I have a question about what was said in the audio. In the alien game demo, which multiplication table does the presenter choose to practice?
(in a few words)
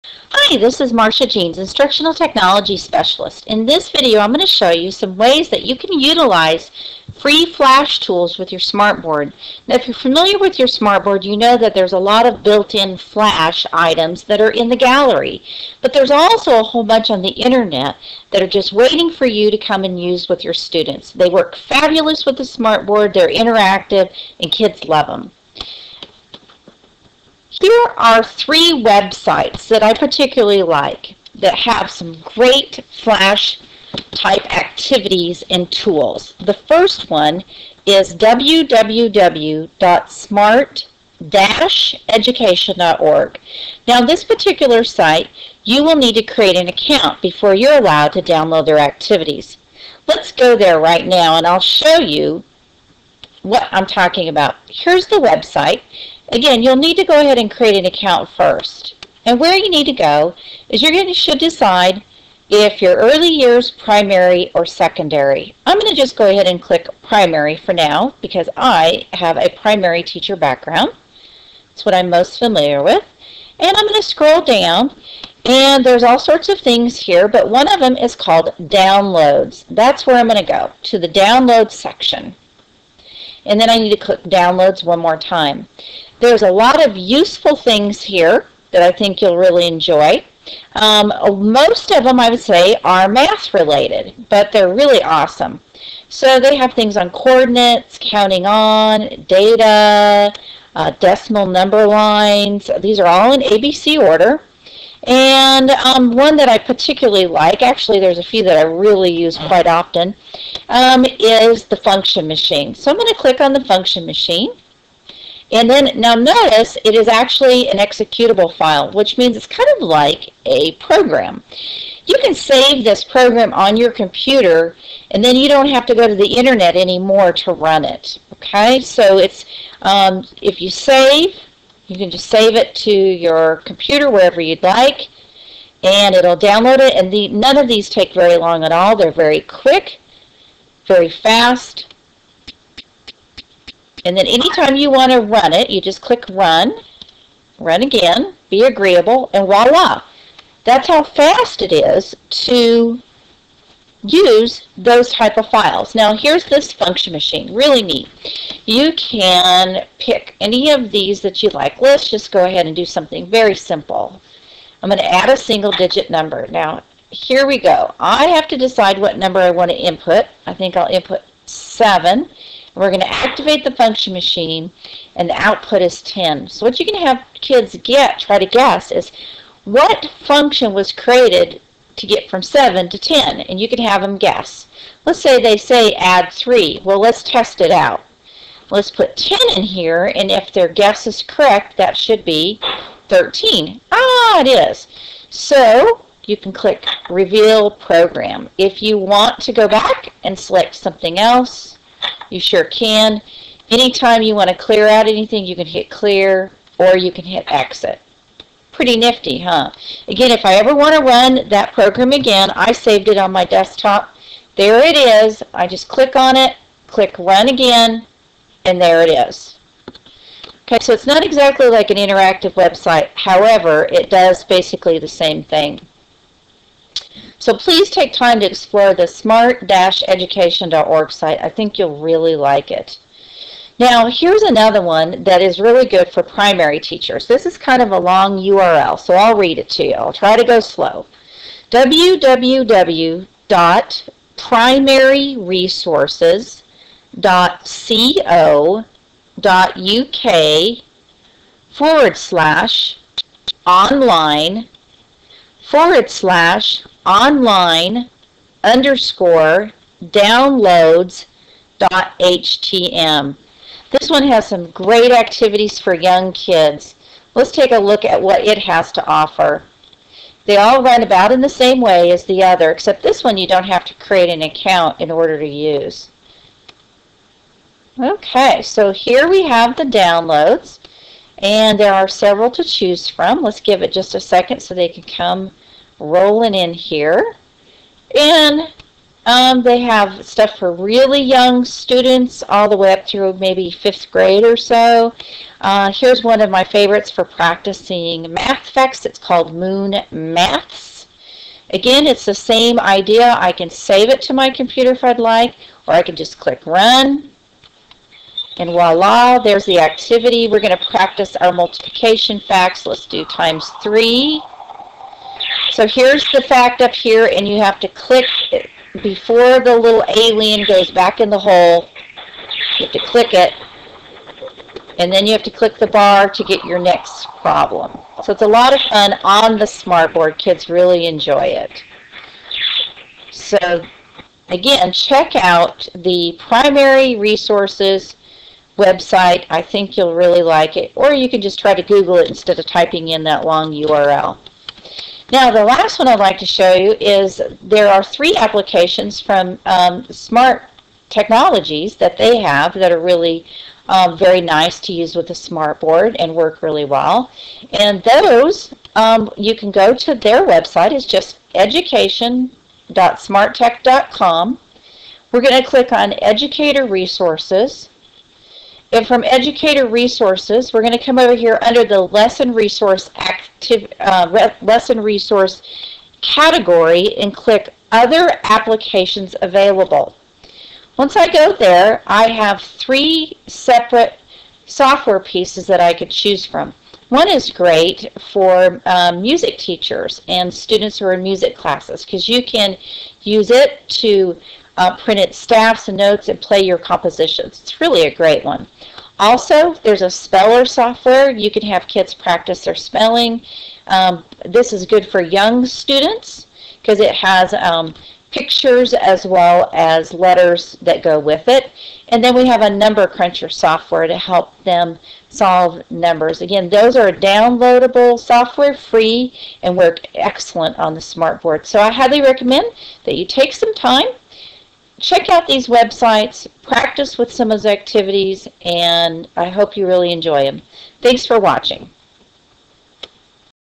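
Times 3.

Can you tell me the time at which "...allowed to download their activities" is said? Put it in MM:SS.
00:47.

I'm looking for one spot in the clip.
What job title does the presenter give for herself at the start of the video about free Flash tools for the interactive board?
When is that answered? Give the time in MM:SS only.
00:01.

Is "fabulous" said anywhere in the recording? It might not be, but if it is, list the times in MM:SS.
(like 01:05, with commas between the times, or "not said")
00:21.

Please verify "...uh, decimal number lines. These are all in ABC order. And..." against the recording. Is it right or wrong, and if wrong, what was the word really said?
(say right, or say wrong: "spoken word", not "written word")
right.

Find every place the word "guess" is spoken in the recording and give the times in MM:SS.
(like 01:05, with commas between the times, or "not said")
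02:58, 03:04, 03:10.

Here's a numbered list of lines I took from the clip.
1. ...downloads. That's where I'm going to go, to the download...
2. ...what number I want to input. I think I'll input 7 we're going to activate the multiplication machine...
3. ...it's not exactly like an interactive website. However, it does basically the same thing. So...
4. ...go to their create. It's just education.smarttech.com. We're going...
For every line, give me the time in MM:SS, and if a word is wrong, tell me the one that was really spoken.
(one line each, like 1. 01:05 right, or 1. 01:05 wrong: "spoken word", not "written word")
1. 01:18 right
2. 02:48 wrong: "function", not "multiplication"
3. 03:40 right
4. 05:59 wrong: "website", not "create".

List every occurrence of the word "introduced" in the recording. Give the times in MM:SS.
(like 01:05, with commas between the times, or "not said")
not said.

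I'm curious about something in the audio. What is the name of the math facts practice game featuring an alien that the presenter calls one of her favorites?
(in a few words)
Moon Maths.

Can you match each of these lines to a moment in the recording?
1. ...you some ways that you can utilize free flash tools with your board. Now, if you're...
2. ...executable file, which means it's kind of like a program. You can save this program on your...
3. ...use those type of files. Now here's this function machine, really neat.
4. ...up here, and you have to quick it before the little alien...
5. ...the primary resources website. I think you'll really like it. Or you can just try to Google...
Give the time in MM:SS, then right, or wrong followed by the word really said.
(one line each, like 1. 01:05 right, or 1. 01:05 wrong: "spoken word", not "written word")
1. 00:04 wrong: "smartboard", not "board"
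2. 01:57 right
3. 02:34 right
4. 05:16 wrong: "click", not "quick"
5. 05:35 right.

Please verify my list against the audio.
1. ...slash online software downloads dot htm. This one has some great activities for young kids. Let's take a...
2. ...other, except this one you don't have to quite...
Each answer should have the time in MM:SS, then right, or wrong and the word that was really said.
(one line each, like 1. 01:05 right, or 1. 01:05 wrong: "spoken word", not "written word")
1. 04:16 wrong: "underscore", not "software"
2. 04:32 wrong: "create", not "quite".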